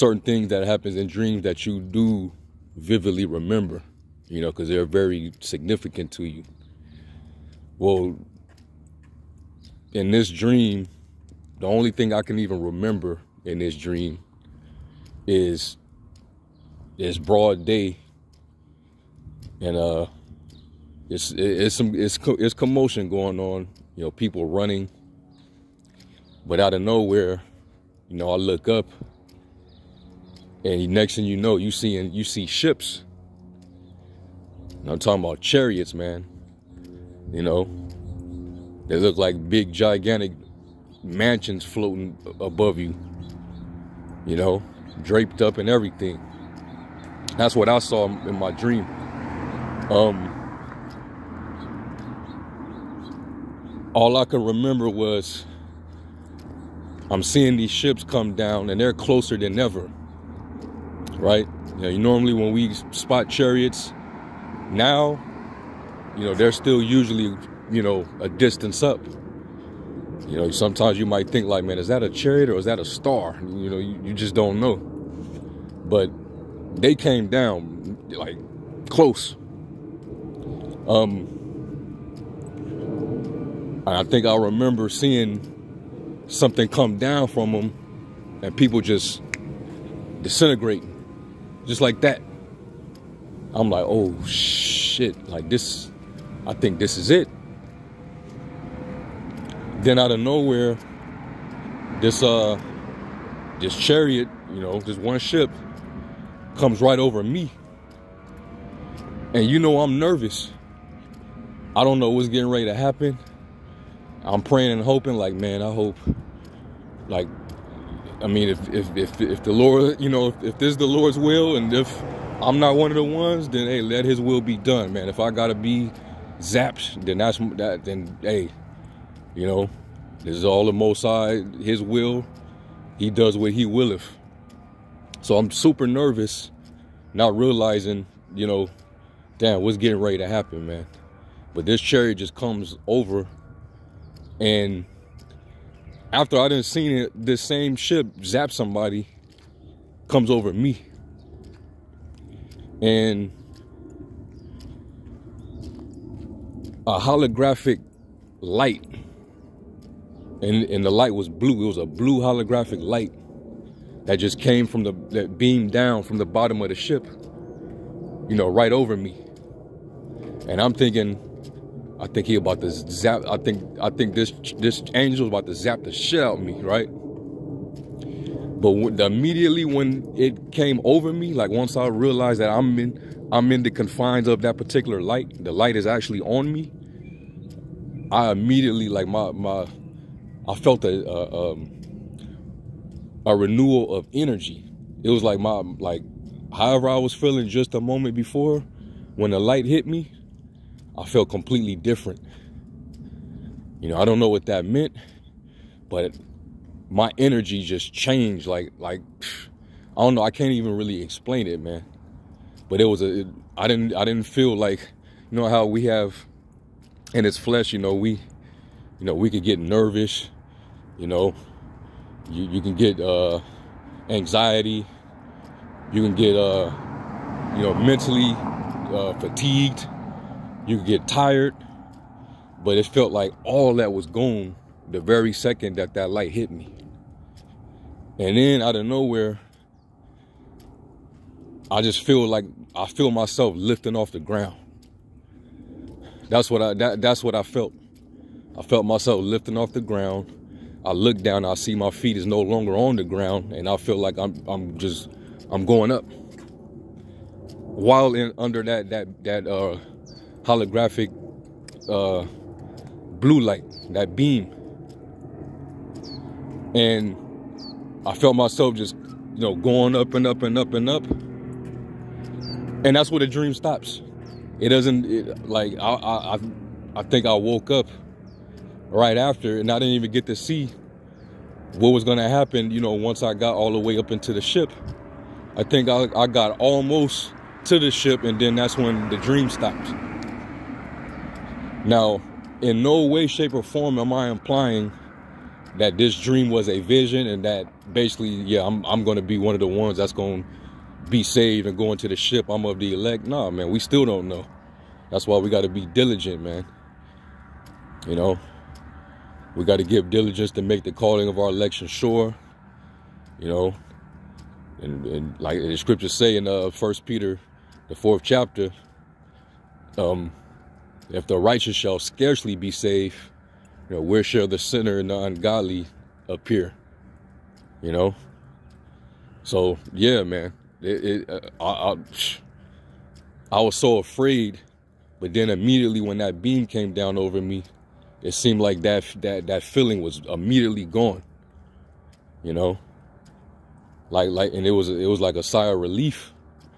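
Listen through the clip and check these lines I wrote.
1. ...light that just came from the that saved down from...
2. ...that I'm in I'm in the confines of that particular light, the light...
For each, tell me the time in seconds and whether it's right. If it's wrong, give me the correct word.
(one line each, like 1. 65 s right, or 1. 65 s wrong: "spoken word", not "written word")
1. 162 s wrong: "beamed", not "saved"
2. 182 s right.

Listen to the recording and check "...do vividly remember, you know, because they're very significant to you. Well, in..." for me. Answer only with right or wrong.
right.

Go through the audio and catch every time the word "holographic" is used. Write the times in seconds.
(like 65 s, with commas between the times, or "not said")
156 s, 162 s, 260 s.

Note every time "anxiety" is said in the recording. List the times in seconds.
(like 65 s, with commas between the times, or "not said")
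224 s.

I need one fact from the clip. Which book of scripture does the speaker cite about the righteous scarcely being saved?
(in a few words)
First Peter.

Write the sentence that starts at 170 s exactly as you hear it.
And I'm thinking, I think he about to zap.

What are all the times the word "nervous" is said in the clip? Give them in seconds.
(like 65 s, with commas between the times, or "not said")
109 s, 135 s, 219 s.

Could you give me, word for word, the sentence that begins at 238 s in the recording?
And then out of nowhere, I just feel like I feel myself lifting off the ground.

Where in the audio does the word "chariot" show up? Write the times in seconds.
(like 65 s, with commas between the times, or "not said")
35 s, 63 s, 72 s, 103 s, 141 s.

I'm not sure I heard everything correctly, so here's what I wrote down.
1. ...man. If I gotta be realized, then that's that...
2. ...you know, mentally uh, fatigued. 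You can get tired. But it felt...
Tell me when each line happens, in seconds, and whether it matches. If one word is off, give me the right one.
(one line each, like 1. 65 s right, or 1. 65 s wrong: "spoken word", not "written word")
1. 124 s wrong: "zapped", not "realized"
2. 227 s right.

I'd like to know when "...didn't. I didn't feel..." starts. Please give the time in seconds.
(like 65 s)
213 s.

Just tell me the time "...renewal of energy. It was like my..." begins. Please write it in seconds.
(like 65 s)
193 s.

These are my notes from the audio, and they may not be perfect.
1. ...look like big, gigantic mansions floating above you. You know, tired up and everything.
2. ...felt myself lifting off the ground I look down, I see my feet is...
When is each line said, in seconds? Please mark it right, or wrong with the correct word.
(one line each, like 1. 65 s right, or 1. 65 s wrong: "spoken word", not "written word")
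1. 38 s wrong: "draped", not "tired"
2. 248 s right.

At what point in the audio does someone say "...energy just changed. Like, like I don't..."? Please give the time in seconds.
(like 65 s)
207 s.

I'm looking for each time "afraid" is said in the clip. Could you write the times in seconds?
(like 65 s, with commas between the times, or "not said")
333 s.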